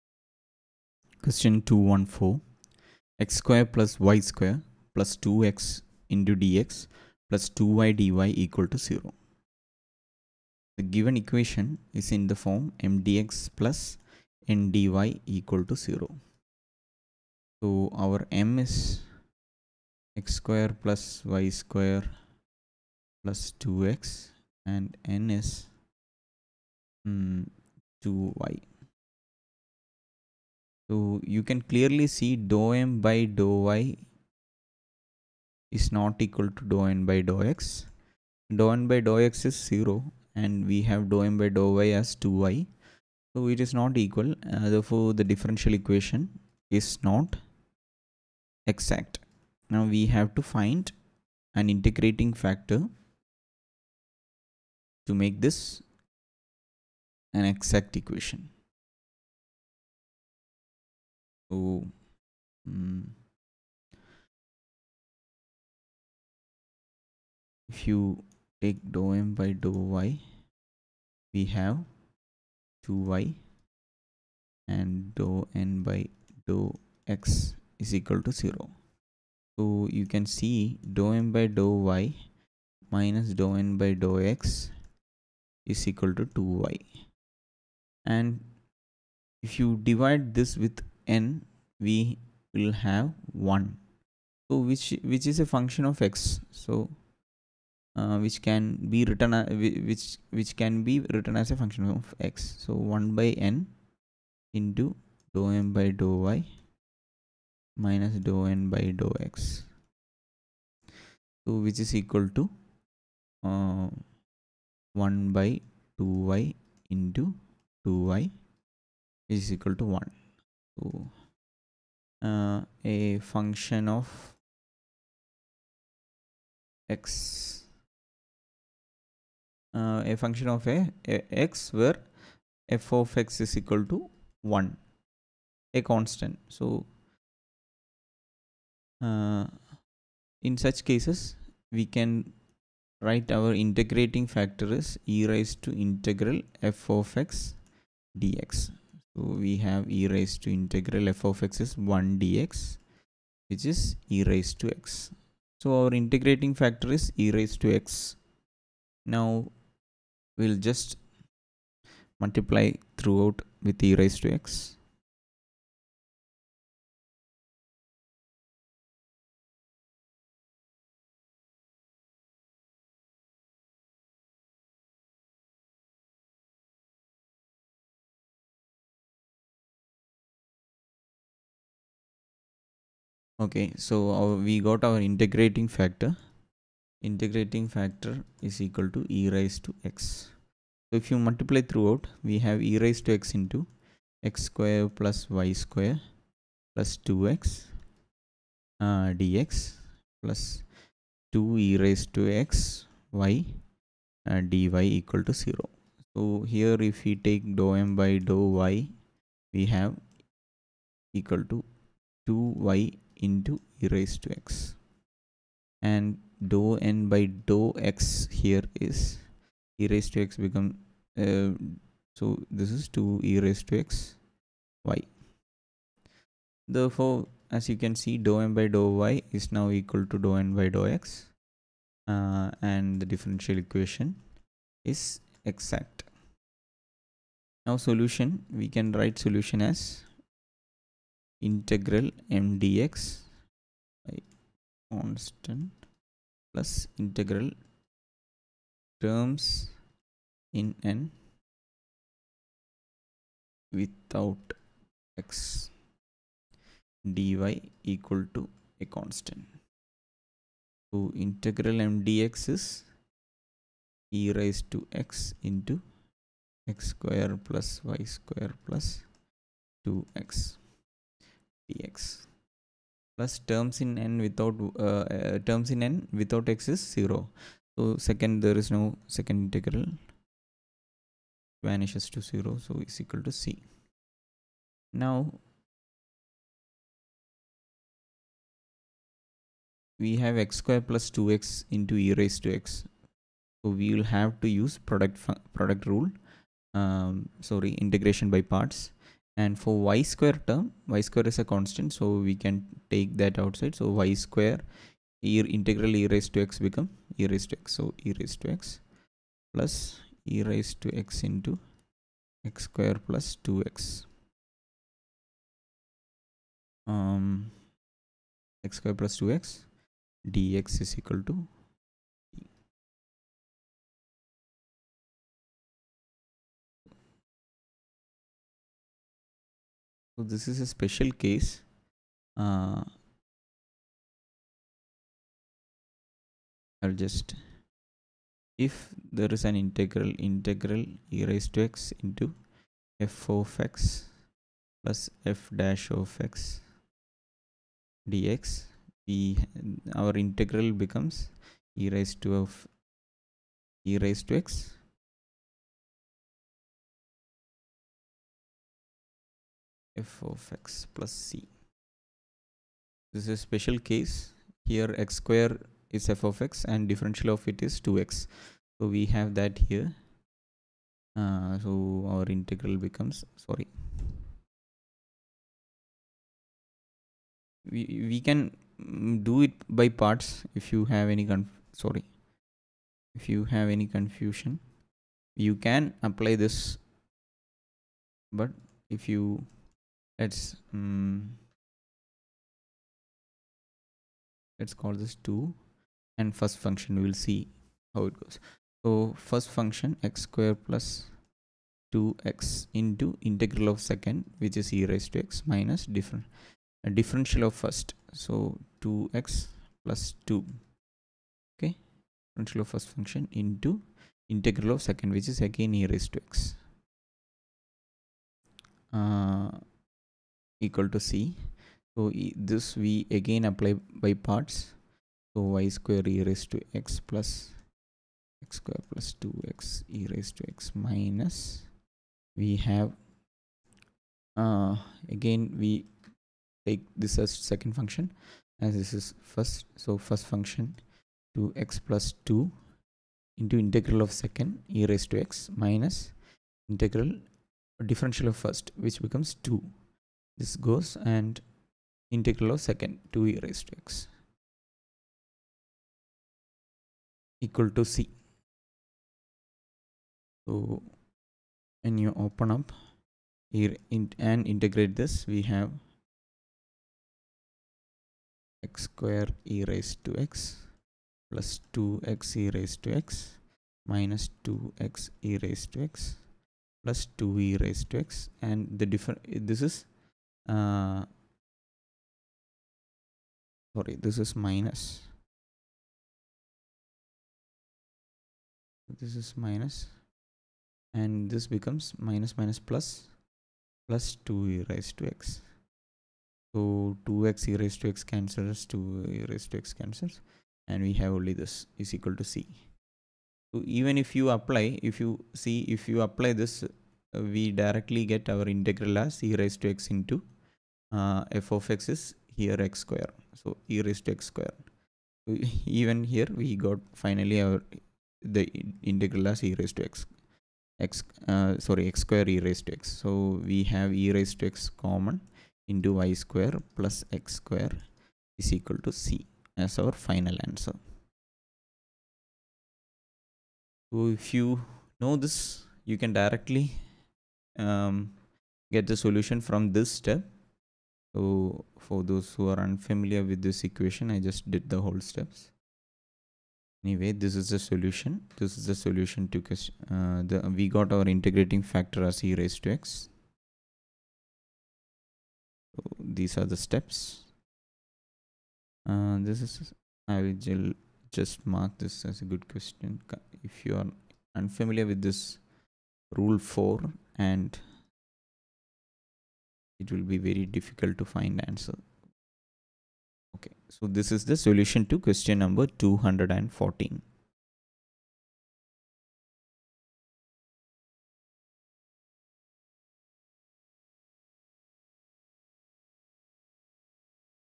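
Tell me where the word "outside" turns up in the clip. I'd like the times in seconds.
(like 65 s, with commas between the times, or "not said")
303 s.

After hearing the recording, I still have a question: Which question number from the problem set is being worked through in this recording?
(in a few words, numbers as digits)
214.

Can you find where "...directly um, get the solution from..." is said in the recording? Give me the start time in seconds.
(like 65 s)
536 s.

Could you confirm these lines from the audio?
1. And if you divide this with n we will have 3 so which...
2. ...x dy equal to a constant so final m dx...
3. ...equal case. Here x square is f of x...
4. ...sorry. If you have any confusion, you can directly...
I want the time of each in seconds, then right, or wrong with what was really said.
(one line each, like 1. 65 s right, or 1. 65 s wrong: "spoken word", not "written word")
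1. 88 s wrong: "1", not "3"
2. 255 s wrong: "integral", not "final"
3. 363 s wrong: "special", not "equal"
4. 381 s wrong: "apply", not "directly".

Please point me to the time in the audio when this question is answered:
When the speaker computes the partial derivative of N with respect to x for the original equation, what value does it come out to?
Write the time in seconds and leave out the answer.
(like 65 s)
38 s.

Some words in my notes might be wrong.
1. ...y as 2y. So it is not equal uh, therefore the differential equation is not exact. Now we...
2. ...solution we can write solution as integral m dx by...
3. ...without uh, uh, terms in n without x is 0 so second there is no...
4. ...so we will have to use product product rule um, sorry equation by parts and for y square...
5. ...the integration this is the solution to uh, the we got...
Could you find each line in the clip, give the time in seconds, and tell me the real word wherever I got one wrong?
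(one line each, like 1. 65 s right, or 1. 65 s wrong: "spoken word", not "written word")
1. 41 s right
2. 237 s right
3. 274 s right
4. 292 s wrong: "integration", not "equation"
5. 547 s wrong: "solution", not "integration".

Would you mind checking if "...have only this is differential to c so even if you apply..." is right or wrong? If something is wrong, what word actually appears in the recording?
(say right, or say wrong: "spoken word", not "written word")
wrong: "equal", not "differential".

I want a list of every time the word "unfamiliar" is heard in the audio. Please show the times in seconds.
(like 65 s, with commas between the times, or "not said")
542 s, 564 s.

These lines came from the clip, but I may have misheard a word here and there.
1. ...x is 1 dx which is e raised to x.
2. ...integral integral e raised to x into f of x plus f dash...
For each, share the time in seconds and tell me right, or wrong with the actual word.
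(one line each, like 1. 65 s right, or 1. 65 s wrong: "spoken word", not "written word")
1. 151 s right
2. 339 s right.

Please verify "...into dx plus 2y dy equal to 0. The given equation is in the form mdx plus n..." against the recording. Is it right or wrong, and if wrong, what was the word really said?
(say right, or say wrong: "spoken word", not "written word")
right.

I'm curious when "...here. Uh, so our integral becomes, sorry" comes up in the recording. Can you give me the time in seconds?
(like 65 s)
369 s.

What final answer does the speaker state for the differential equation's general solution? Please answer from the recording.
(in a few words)
e^x(y^2 + x^2) = c.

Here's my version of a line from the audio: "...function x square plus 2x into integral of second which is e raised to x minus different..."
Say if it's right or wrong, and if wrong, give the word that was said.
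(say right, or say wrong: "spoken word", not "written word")
right.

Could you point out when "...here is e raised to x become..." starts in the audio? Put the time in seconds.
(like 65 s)
218 s.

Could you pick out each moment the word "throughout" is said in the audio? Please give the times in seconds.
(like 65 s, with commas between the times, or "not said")
162 s, 191 s.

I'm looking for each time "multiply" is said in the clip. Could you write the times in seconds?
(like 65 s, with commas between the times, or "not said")
162 s, 191 s.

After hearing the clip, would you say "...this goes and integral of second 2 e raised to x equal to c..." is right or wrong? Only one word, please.
right.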